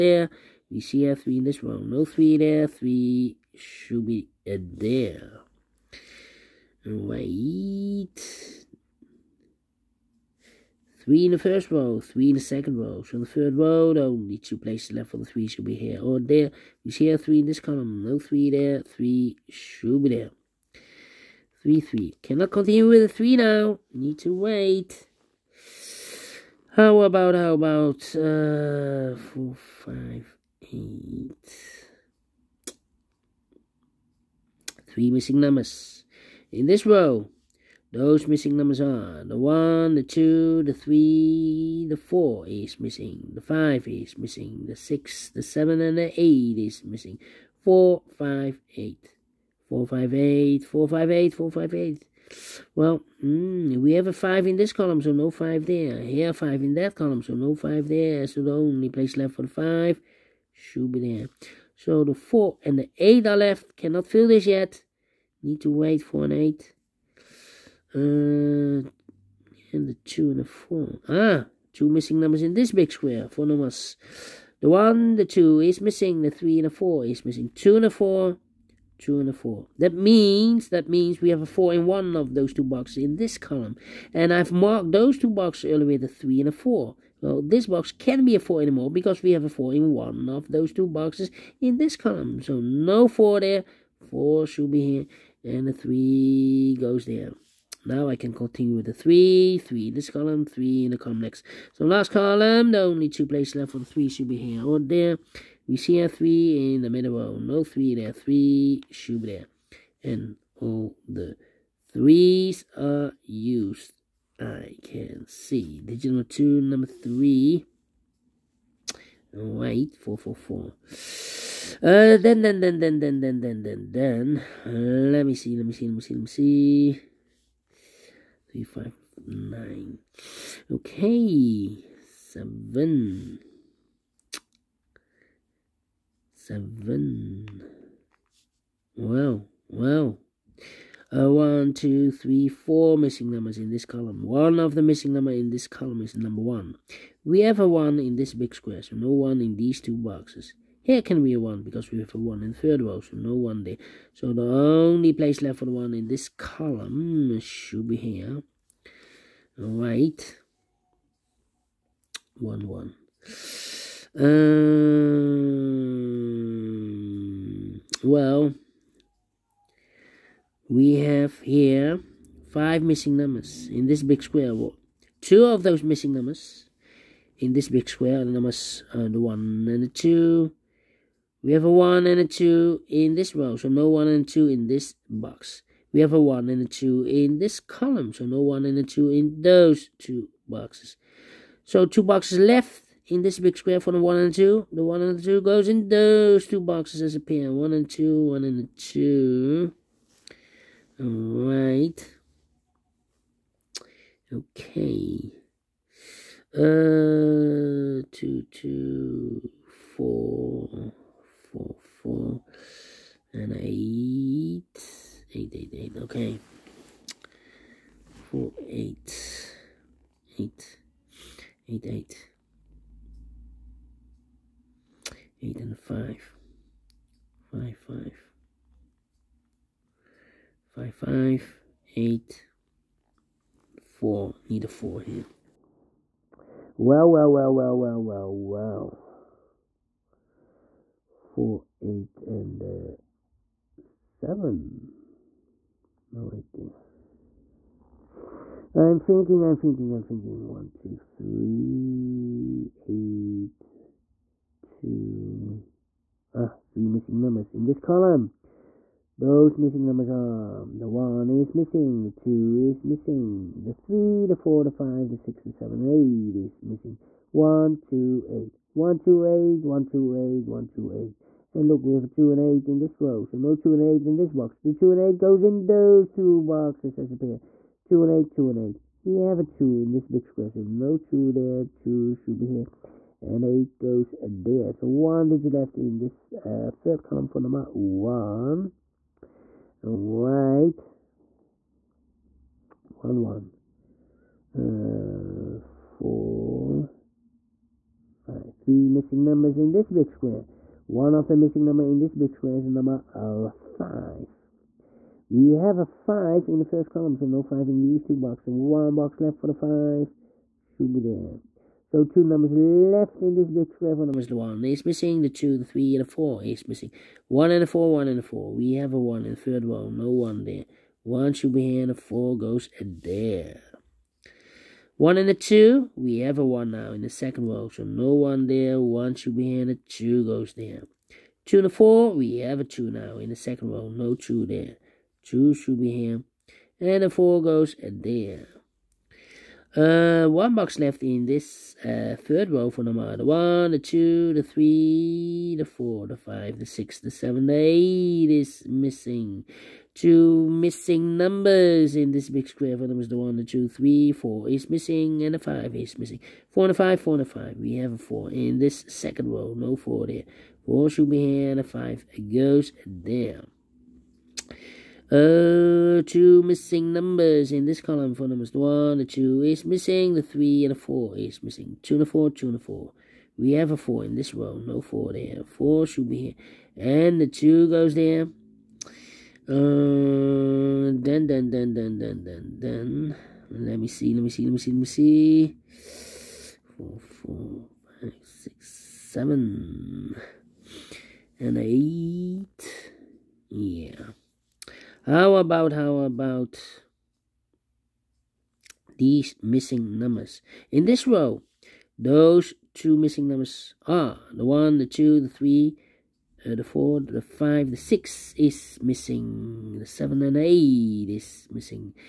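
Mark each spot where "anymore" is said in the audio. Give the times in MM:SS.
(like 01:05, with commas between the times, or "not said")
01:28.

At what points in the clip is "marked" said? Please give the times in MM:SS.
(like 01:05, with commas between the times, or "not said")
01:24.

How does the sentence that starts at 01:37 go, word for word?
Now I can continue with the 3, 3 this column, 3 in the column next.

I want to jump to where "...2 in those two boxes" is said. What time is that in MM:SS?
03:08.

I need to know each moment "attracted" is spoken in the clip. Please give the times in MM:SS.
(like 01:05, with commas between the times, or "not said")
not said.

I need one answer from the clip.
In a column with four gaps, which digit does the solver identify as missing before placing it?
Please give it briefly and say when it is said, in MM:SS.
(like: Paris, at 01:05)
1, at 02:26.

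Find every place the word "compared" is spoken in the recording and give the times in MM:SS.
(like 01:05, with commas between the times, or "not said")
not said.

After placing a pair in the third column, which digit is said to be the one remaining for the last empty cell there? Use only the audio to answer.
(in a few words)
1.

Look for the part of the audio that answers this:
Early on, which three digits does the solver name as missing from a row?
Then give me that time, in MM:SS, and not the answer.
00:47.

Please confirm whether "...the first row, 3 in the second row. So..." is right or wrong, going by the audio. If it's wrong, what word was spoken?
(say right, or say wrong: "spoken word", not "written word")
right.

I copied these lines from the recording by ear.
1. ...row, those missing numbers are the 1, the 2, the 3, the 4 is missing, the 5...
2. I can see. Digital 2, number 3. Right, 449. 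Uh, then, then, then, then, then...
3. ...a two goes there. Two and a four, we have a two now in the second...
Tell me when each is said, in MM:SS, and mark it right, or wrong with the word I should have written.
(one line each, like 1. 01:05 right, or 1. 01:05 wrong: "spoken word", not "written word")
1. 00:36 right
2. 01:54 wrong: "444", not "449"
3. 05:29 right.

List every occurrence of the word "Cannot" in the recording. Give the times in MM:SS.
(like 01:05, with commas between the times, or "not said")
00:22, 01:03.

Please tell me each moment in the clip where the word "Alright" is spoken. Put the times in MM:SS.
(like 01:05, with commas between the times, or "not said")
03:21.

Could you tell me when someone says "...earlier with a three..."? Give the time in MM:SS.
01:25.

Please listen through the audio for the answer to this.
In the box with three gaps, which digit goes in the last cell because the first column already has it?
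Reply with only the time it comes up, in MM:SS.
05:03.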